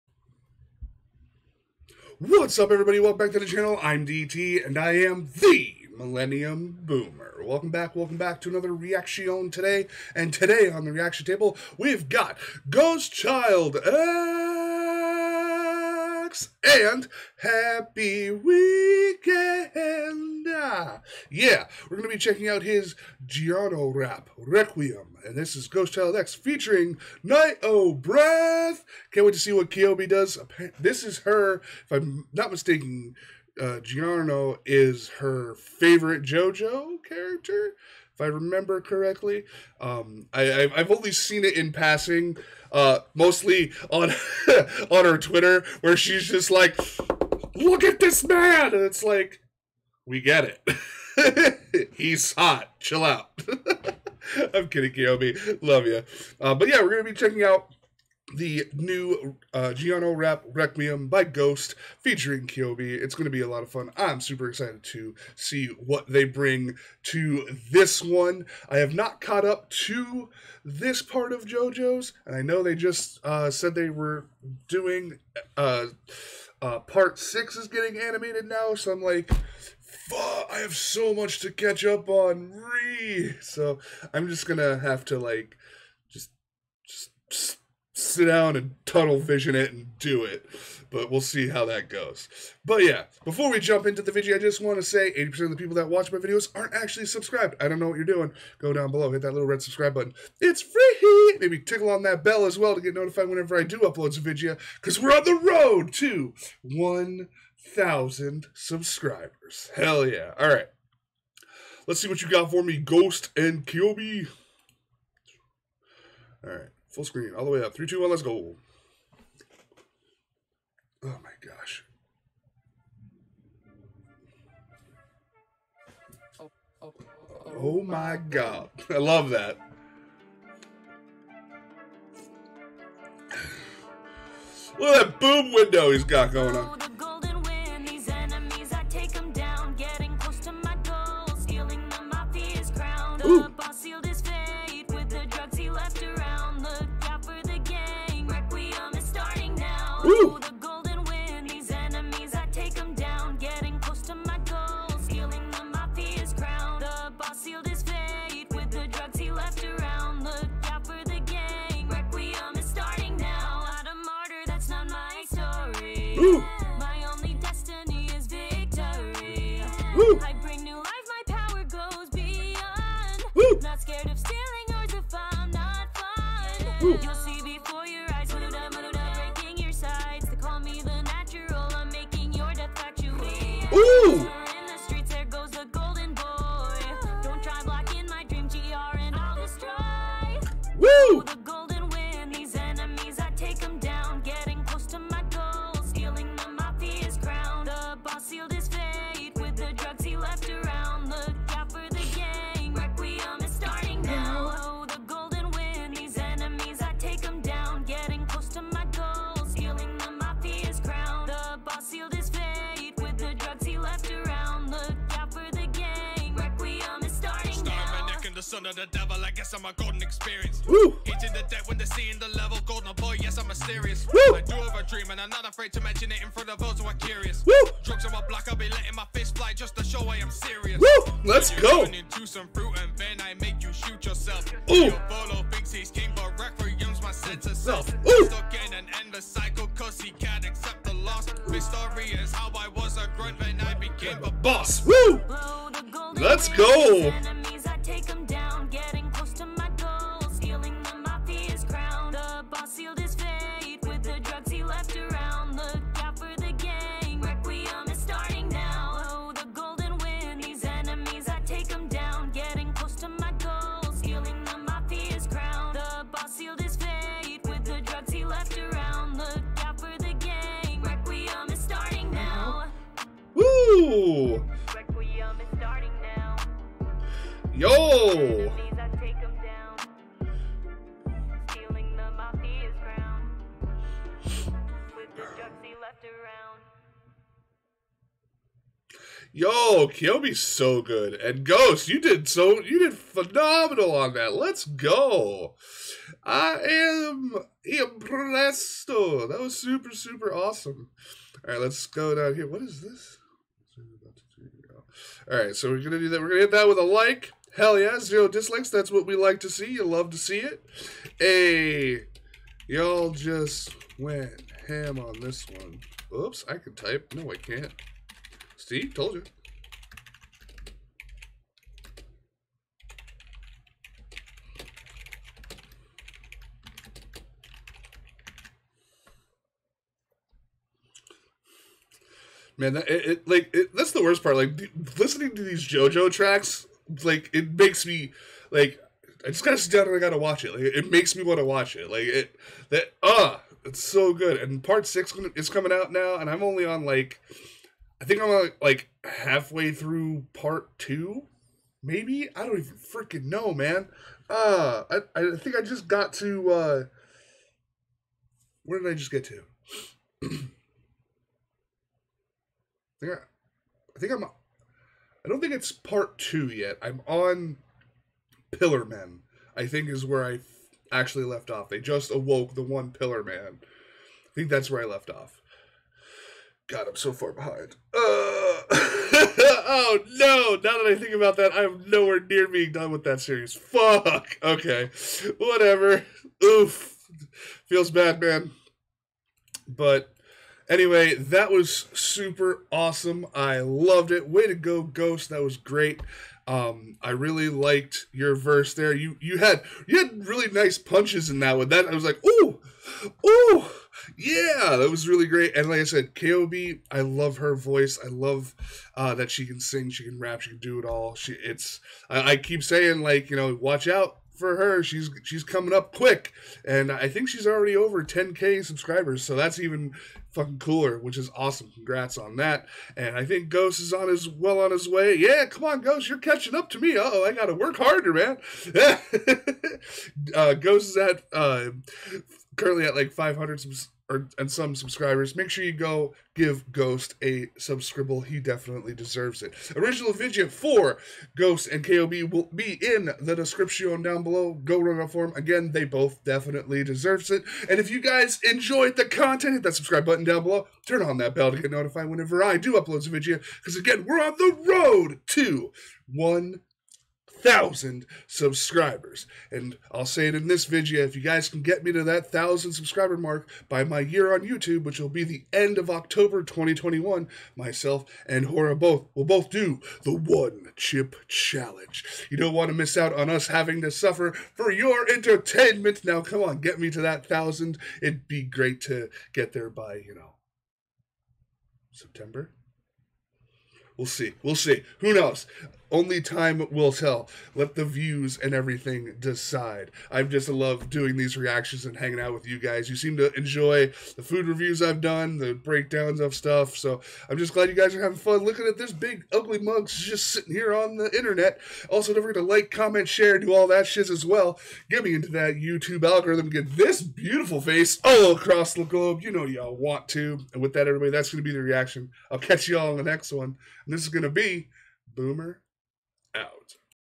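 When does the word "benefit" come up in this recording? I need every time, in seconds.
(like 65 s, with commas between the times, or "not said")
not said.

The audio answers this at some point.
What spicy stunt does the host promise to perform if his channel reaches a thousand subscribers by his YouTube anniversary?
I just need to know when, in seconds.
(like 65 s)
470 s.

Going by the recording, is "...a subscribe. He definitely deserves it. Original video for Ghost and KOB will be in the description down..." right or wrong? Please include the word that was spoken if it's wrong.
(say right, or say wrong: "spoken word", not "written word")
right.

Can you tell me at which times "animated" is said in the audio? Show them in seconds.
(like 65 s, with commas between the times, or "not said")
77 s.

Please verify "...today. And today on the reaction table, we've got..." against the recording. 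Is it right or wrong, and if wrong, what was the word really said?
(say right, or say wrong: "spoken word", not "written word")
right.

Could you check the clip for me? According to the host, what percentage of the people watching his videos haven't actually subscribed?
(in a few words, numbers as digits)
80%.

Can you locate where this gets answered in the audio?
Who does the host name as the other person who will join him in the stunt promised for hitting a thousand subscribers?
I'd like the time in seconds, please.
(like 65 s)
468 s.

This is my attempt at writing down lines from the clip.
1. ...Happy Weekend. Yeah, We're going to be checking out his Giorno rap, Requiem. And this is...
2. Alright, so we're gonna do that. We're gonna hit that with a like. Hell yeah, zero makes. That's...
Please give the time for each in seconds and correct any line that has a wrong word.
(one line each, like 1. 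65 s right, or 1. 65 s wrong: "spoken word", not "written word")
1. 17 s right
2. 305 s wrong: "dislikes", not "makes".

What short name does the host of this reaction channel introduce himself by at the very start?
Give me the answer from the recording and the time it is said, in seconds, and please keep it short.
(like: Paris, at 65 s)
DT, at 4 s.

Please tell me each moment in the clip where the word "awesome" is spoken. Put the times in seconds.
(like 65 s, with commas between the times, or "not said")
300 s, 392 s, 421 s.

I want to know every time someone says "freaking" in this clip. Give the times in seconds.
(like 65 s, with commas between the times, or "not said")
352 s.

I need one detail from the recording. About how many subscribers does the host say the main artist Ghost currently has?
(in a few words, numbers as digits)
500.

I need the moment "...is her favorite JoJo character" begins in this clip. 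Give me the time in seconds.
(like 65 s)
34 s.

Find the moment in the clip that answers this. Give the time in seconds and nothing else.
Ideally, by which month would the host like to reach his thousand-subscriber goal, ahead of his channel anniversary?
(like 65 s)
481 s.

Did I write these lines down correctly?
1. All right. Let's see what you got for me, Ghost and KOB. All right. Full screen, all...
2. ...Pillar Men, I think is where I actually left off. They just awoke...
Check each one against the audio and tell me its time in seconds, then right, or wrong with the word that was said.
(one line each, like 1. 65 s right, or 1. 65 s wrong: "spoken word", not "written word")
1. 110 s right
2. 368 s right.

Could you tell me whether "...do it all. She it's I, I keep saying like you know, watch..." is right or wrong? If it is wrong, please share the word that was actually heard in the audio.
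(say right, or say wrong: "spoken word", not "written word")
right.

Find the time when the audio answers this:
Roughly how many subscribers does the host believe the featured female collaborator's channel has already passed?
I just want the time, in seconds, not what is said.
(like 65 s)
418 s.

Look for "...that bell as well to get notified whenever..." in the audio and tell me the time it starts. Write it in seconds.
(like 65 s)
102 s.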